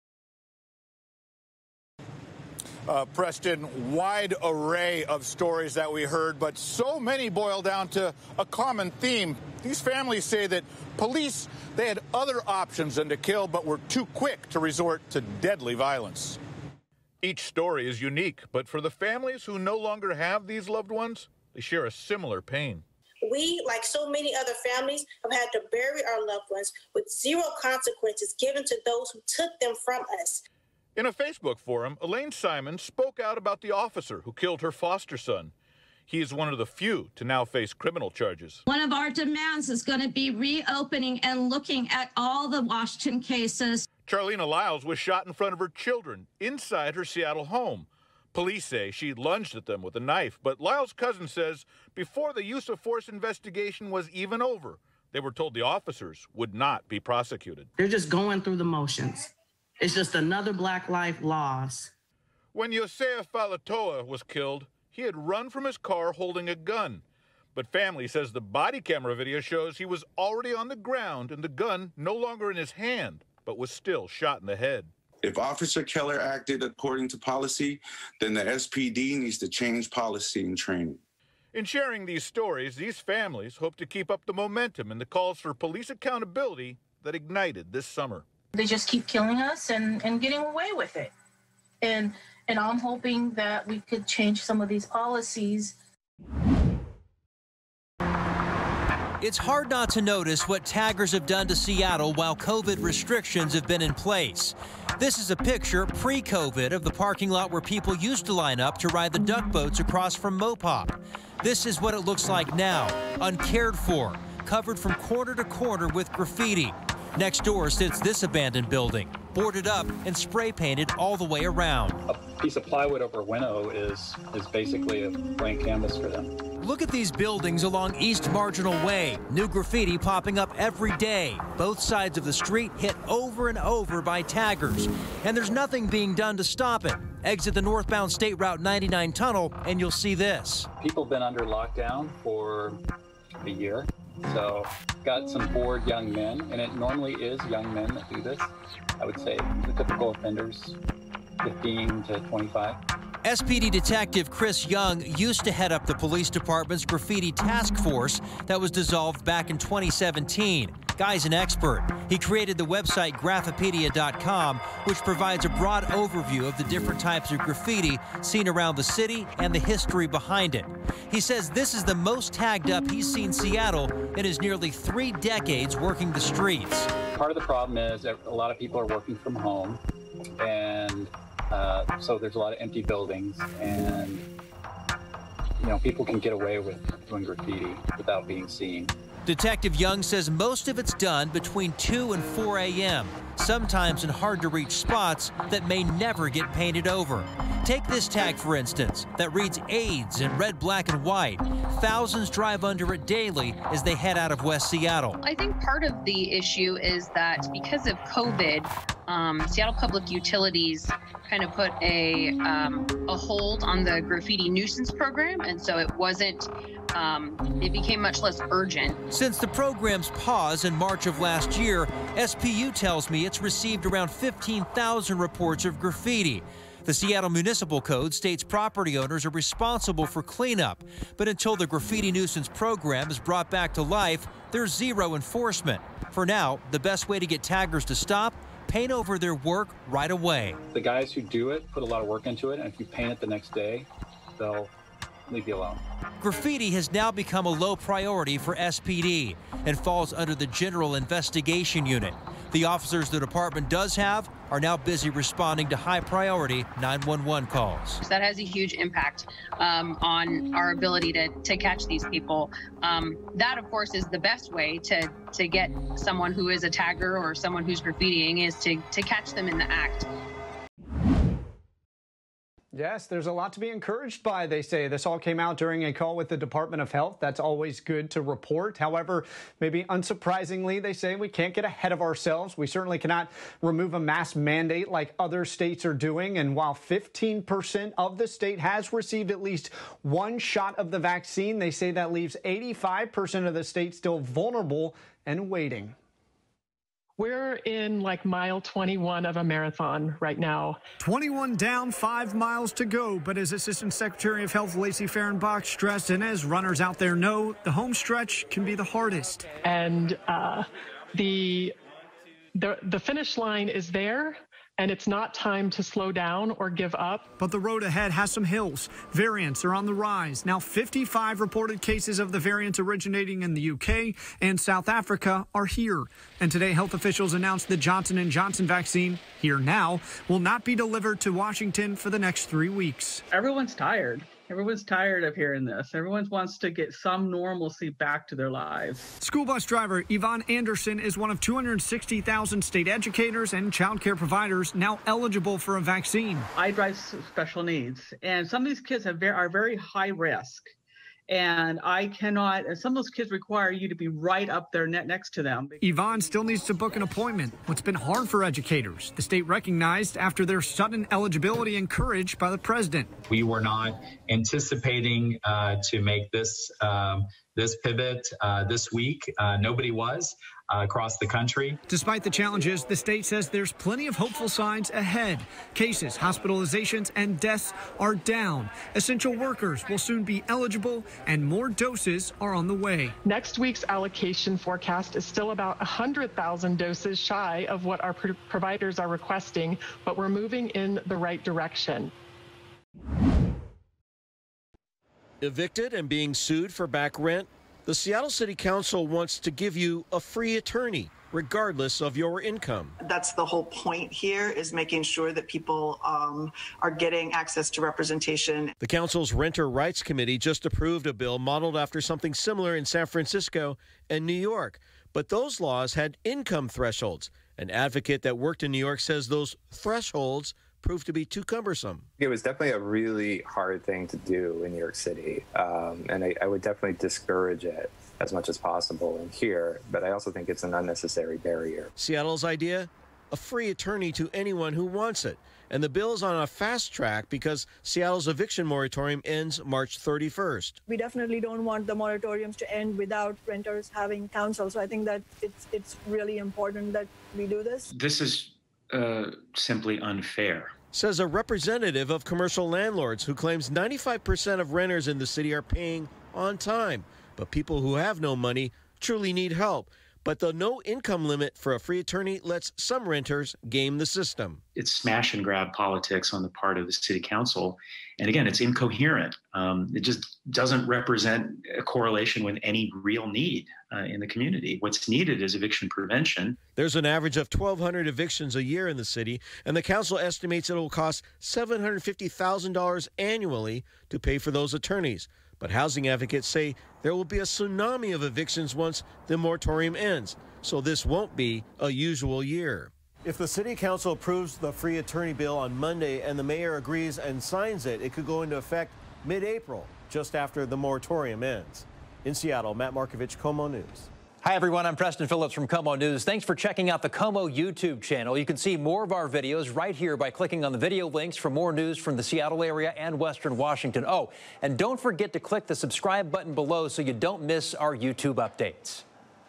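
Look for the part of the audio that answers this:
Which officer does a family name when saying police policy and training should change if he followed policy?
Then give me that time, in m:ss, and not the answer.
1:15.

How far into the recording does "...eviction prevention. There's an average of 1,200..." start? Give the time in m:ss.
7:55.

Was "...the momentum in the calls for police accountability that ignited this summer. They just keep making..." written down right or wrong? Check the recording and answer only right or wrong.
wrong.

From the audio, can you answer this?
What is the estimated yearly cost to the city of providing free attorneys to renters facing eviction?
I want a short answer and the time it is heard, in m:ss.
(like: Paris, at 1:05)
$750,000, at 8:01.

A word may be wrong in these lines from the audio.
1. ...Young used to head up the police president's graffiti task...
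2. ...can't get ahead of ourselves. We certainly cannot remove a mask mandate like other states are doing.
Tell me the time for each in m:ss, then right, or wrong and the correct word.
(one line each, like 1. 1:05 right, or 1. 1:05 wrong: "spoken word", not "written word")
1. 2:34 wrong: "department", not "president"
2. 4:41 right.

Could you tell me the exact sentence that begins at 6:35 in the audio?
Evicted and being sued for back rent?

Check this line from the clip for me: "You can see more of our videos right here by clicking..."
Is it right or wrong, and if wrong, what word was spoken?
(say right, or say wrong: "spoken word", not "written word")
right.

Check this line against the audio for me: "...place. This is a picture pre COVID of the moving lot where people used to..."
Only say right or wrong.
wrong.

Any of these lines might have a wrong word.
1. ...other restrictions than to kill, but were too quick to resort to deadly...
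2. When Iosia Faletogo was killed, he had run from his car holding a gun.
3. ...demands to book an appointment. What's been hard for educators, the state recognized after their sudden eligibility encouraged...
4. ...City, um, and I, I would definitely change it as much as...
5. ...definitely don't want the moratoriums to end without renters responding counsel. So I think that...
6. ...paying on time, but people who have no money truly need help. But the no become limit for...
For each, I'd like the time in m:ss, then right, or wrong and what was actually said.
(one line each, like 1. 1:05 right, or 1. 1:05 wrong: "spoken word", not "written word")
1. 0:12 wrong: "options", not "restrictions"
2. 1:02 right
3. 5:56 wrong: "needs", not "demands"
4. 7:04 wrong: "discourage", not "change"
5. 7:20 wrong: "having", not "responding"
6. 7:35 wrong: "income", not "become".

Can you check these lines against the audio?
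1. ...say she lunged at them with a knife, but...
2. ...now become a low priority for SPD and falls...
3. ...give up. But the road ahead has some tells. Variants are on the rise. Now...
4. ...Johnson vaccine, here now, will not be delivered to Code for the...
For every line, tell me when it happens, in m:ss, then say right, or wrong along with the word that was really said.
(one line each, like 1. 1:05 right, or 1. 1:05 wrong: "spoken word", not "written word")
1. 0:48 right
2. 4:06 right
3. 5:16 wrong: "hills", not "tells"
4. 5:28 wrong: "Washington", not "Code".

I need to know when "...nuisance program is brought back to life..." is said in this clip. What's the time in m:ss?
3:52.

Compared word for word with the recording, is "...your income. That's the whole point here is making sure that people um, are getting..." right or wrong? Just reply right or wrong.
right.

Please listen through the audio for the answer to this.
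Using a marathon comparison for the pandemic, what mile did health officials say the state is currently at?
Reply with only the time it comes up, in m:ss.
4:58.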